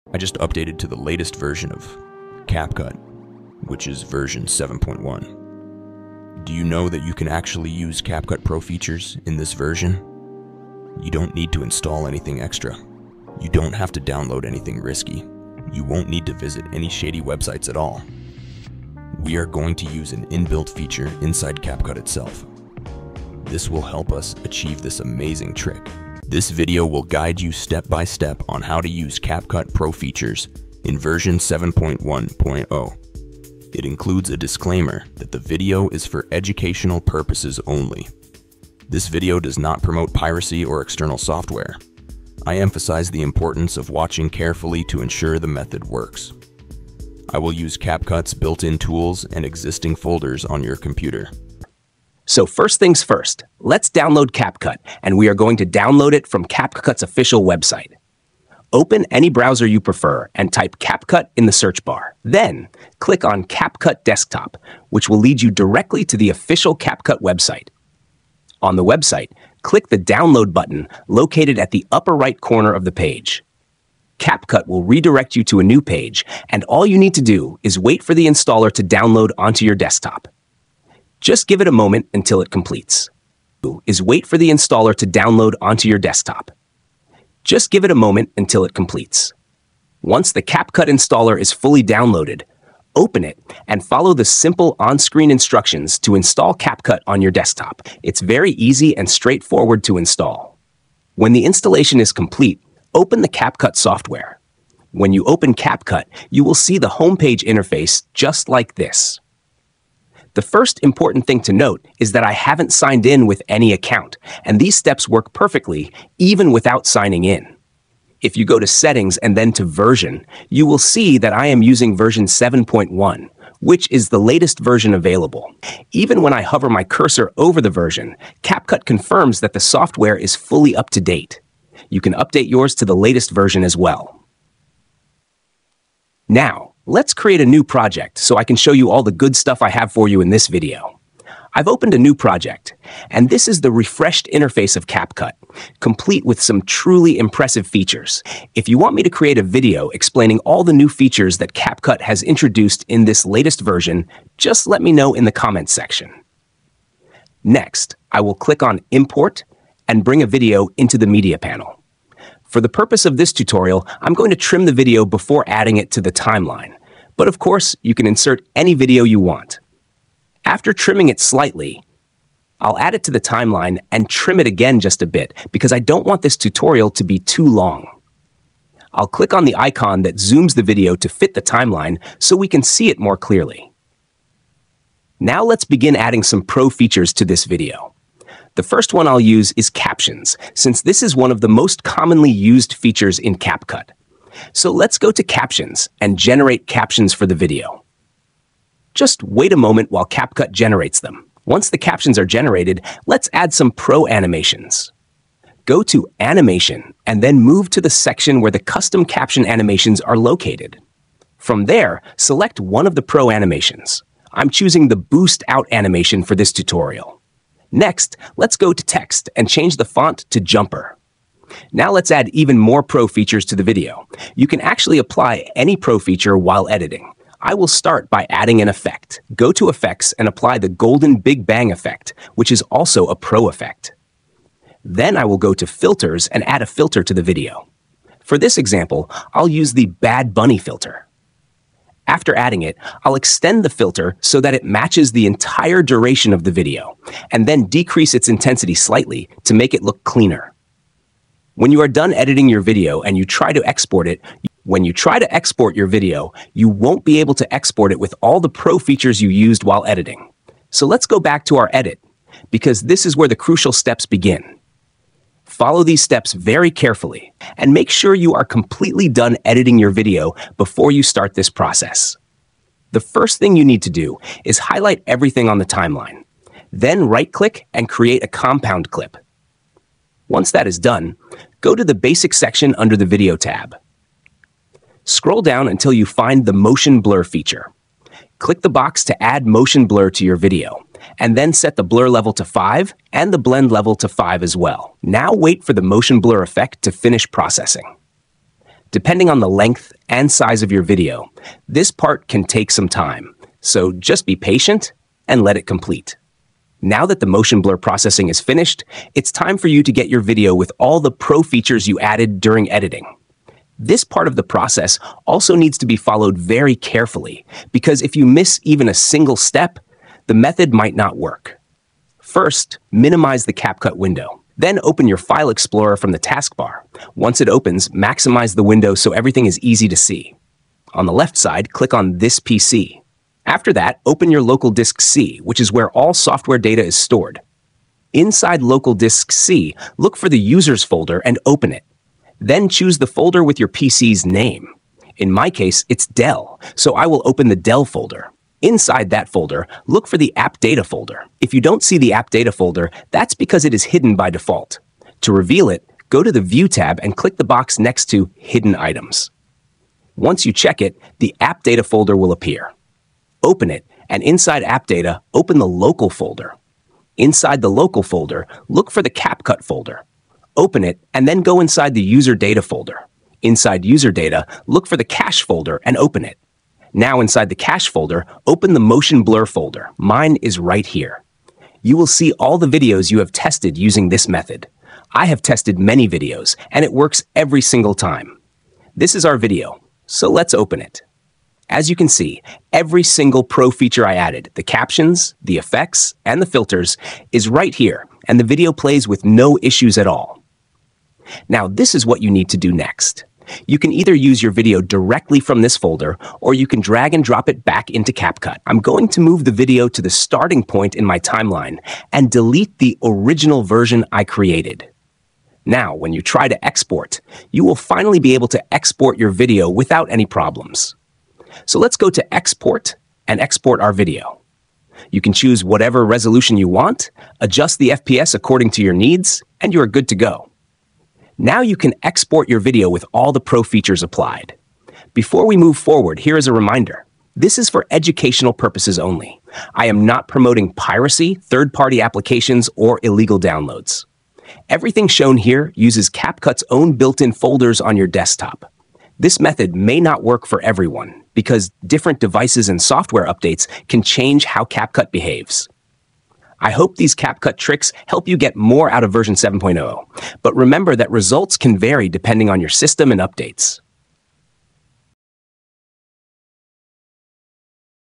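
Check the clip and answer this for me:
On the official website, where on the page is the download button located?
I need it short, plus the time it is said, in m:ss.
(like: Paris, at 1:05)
upper right corner, at 1:11.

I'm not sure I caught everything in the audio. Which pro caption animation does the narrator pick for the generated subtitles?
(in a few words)
Boost Out.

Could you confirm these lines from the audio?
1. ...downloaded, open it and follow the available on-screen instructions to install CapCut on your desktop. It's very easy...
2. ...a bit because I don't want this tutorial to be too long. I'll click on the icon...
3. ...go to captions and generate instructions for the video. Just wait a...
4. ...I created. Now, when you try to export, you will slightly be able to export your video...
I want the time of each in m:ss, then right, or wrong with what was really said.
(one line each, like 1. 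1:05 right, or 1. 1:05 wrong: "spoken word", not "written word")
1. 1:31 wrong: "simple", not "available"
2. 2:55 right
3. 3:14 wrong: "captions", not "instructions"
4. 6:54 wrong: "finally", not "slightly".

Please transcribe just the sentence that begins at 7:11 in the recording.
Now you can export your video with all the pro features applied.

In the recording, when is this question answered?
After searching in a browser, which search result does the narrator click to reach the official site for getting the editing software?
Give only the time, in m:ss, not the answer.
1:03.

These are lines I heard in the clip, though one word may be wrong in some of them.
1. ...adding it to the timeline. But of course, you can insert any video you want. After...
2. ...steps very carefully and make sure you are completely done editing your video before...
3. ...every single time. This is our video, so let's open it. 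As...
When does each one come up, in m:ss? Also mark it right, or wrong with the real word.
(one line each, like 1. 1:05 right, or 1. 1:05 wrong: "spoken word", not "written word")
1. 2:45 right
2. 4:26 right
3. 6:27 right.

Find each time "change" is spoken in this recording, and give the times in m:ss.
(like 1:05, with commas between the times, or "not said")
3:39, 7:34.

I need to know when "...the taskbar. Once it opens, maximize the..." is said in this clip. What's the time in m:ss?
5:26.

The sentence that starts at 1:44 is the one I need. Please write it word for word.
When you open CapCut, you will see the homepage interface just like this.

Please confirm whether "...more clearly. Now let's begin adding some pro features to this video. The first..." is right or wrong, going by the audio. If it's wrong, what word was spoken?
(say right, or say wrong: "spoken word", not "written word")
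right.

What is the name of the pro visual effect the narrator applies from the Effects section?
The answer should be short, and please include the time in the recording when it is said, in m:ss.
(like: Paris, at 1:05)
Golden Big Bang, at 3:50.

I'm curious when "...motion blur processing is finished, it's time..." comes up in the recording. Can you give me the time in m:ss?
5:07.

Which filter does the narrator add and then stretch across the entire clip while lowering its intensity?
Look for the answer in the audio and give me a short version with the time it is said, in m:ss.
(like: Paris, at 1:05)
Bad Bunny, at 3:59.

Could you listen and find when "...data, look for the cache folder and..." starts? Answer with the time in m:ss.
6:14.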